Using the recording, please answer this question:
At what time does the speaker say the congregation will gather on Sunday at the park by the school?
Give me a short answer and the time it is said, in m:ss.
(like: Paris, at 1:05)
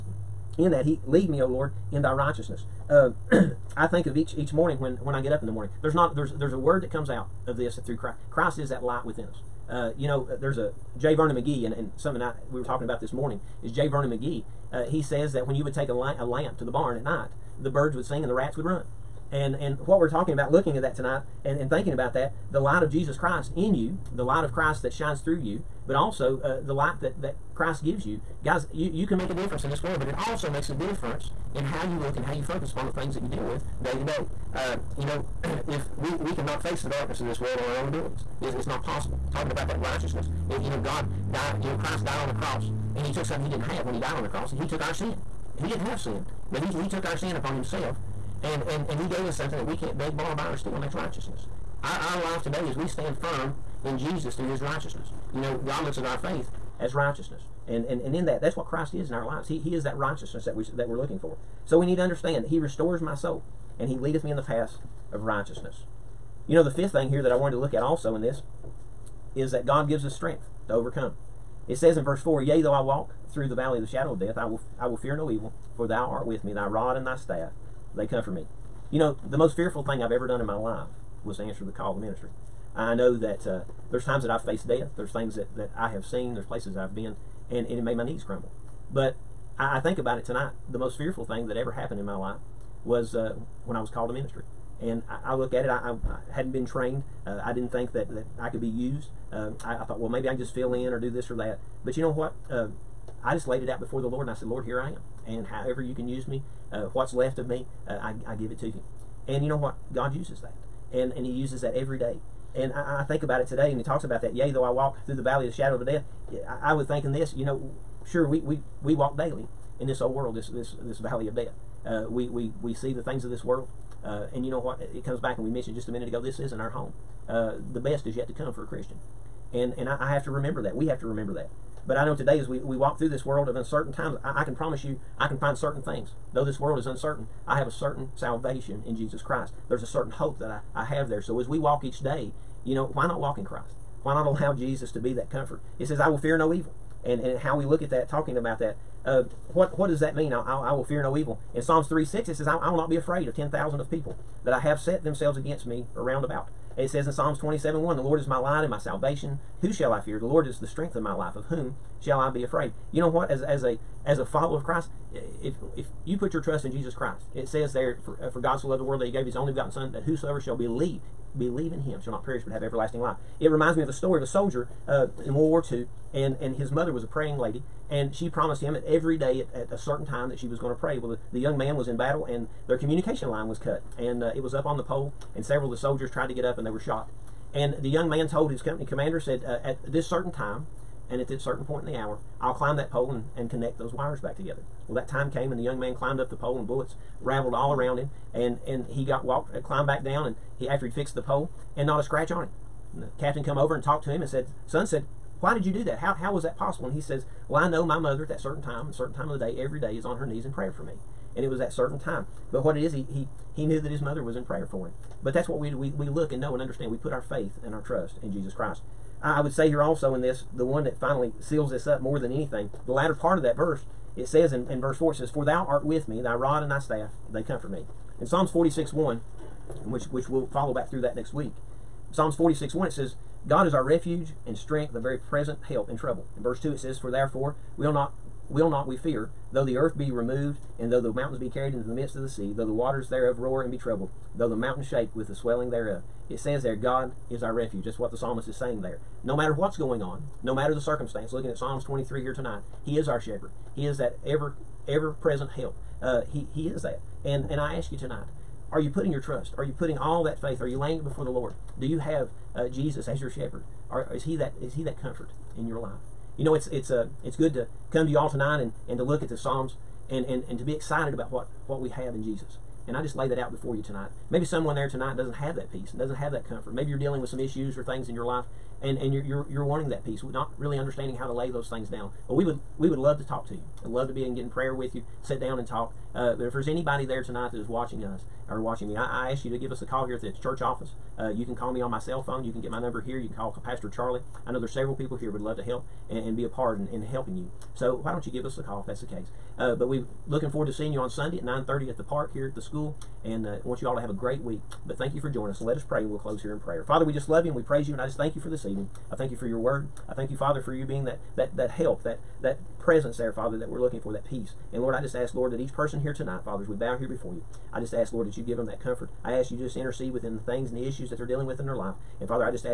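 9:30, at 5:01.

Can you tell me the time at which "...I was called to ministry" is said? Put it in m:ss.
1:33.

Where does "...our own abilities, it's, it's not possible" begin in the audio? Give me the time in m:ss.
0:37.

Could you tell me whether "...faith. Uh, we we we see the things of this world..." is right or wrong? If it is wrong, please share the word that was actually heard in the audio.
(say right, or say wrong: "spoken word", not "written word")
wrong: "death", not "faith".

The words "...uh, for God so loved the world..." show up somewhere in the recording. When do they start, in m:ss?
2:48.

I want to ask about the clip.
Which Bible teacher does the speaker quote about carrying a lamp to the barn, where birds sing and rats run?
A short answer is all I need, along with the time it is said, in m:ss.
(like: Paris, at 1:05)
J. Vernon McGee, at 0:13.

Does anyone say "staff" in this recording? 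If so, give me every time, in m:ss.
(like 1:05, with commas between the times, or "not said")
1:17, 3:46.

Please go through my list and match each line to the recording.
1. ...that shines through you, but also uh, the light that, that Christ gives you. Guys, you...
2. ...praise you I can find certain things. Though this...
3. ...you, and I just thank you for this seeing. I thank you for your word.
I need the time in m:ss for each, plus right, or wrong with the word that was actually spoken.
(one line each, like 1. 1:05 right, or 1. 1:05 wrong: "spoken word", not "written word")
1. 0:24 right
2. 2:14 wrong: "promise", not "praise"
3. 5:07 wrong: "evening", not "seeing".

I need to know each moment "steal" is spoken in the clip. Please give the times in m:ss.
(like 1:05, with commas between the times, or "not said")
0:50.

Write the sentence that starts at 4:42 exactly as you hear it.
But we would we would love to talk to you.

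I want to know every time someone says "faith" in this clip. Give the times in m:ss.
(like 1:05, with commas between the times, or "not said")
0:56, 3:37, 4:20.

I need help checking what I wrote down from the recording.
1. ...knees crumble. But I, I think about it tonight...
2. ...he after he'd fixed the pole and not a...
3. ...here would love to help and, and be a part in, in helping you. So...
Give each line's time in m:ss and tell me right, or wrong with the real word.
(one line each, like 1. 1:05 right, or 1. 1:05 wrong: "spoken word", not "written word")
1. 1:28 right
2. 3:20 right
3. 4:55 right.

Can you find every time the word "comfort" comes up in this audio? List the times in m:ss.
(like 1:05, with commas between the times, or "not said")
1:18, 2:25, 3:47, 4:25, 4:36, 5:18.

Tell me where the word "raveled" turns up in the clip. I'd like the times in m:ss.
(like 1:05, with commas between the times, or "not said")
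3:17.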